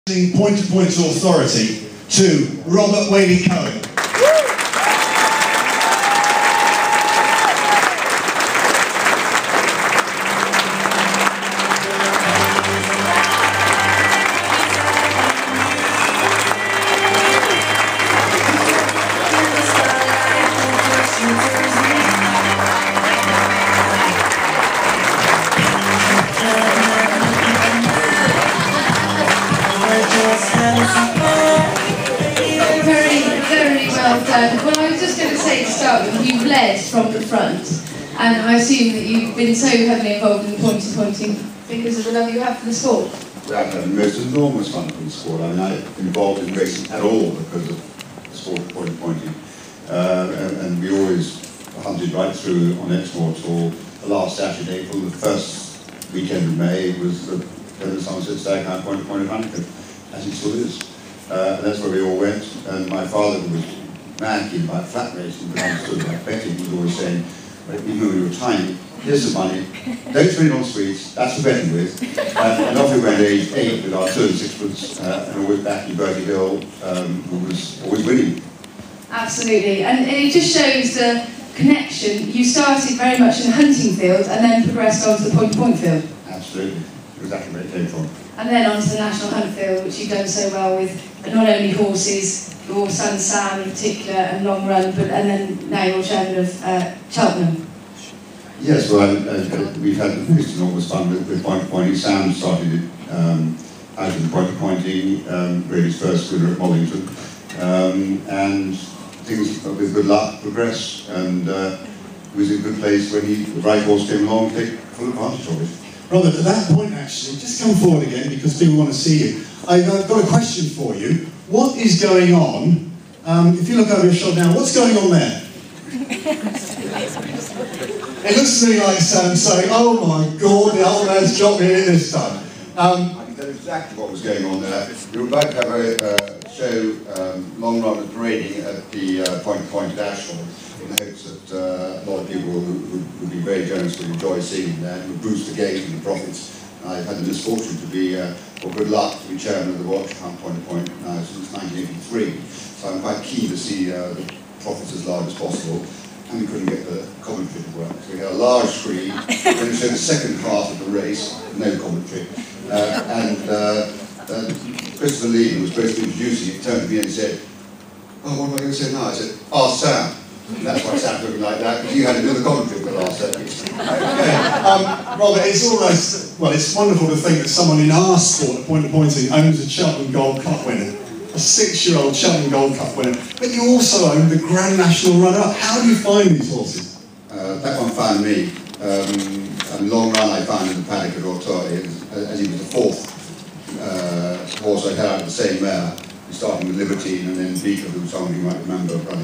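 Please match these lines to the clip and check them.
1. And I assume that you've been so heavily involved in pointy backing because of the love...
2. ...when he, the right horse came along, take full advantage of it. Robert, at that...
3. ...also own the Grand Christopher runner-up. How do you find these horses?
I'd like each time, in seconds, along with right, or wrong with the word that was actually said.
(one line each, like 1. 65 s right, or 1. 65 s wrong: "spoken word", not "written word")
1. 38 s wrong: "pointing", not "backing"
2. 113 s right
3. 183 s wrong: "National", not "Christopher".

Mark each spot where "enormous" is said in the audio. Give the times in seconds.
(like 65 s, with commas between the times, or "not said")
44 s, 100 s.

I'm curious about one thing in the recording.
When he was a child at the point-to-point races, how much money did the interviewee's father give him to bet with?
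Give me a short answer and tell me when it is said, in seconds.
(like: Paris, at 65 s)
two and sixpence, at 74 s.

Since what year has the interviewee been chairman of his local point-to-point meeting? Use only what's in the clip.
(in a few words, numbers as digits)
1983.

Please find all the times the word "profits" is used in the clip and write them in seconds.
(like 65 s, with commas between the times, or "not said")
146 s, 154 s.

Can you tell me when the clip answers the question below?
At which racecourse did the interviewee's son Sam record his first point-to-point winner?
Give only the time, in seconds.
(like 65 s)
106 s.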